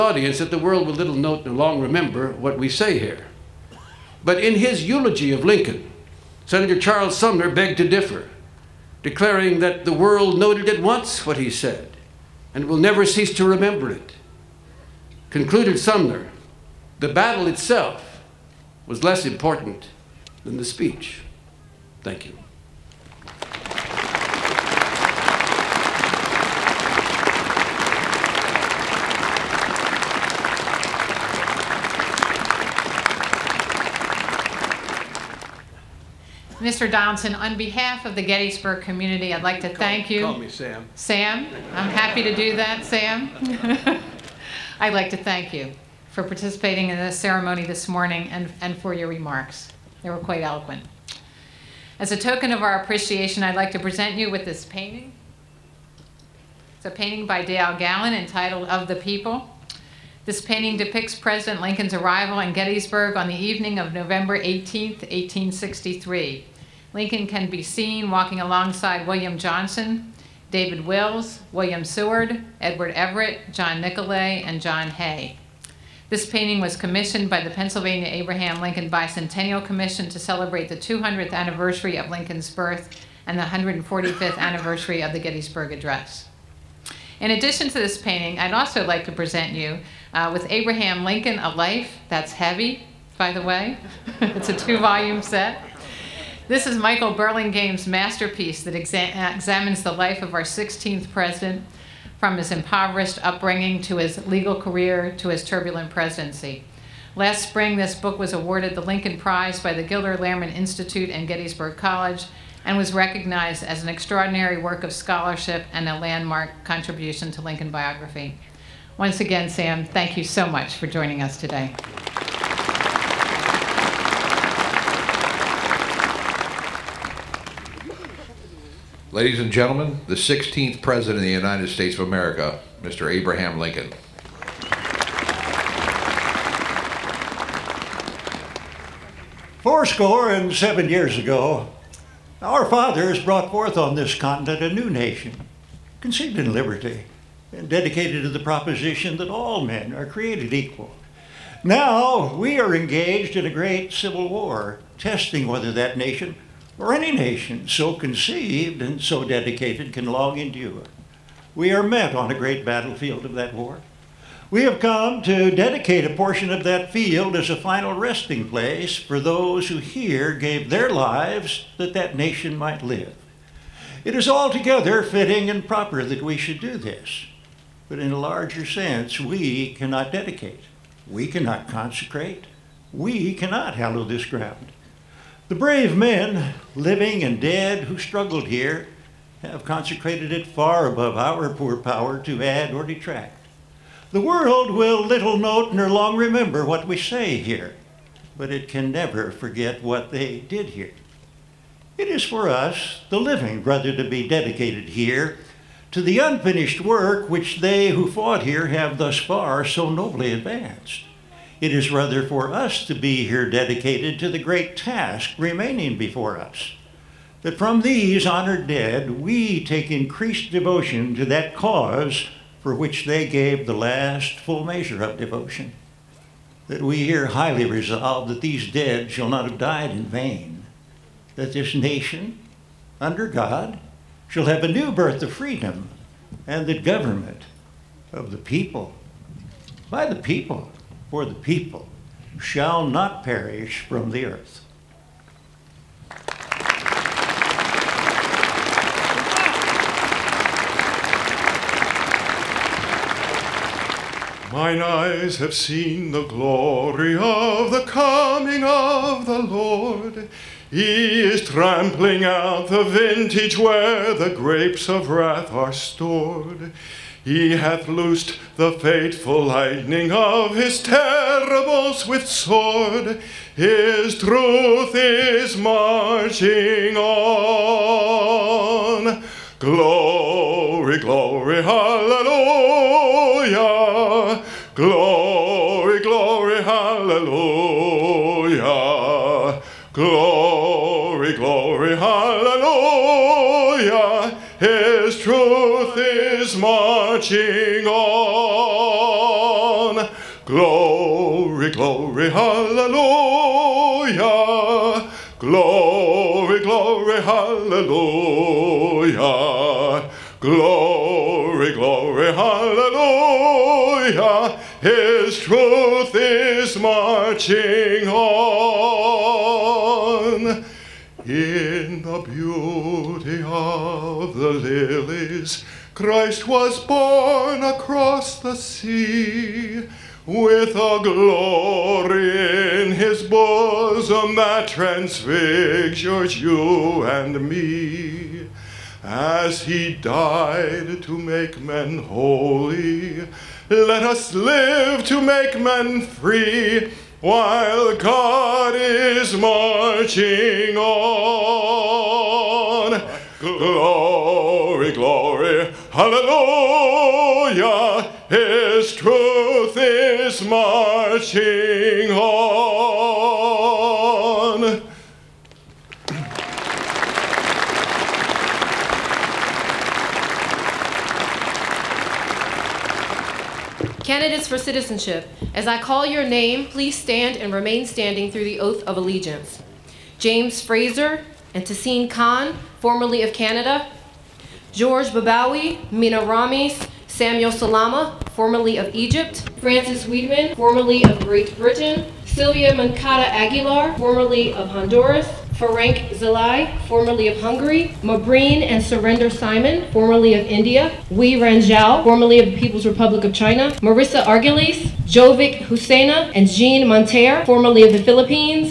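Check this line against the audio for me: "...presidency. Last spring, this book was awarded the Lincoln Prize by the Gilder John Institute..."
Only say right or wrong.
wrong.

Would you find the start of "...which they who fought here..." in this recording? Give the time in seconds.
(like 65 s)
207 s.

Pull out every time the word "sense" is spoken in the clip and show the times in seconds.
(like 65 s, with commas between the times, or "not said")
178 s.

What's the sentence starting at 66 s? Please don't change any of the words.
Lincoln can be seen walking alongside William Johnson, David Wills, William Seward, Edward Everett, John Nicolay, and John Hay.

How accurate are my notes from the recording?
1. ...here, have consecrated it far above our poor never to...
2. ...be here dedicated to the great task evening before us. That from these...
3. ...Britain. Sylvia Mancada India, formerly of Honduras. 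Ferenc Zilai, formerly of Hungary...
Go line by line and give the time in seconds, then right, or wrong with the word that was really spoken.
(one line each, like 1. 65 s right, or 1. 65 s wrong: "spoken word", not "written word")
1. 188 s wrong: "power", not "never"
2. 212 s wrong: "remaining", not "evening"
3. 391 s wrong: "Aguilar", not "India".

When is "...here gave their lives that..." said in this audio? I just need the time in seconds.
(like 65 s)
169 s.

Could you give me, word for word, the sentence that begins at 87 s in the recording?
In addition to this painting, I'd also like to present you uh, with Abraham Lincoln, A Life That's Heavy, by the way.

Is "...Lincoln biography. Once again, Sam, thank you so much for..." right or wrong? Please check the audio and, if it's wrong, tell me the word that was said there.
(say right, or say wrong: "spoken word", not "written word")
right.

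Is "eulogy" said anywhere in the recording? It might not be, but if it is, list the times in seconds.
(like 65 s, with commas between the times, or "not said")
4 s.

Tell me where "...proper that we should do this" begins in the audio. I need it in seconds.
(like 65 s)
175 s.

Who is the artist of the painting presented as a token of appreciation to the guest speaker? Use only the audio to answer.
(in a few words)
Dale Gallon.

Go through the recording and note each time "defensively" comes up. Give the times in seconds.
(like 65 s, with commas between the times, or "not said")
not said.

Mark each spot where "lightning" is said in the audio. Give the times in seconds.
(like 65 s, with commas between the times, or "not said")
269 s.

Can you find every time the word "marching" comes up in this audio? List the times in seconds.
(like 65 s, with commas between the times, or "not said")
275 s, 296 s, 316 s, 349 s, 360 s.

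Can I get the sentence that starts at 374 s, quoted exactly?
Candidates for citizenship, as I call your name, please stand and remain standing through the oath of allegiance.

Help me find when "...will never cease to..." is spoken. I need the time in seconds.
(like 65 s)
12 s.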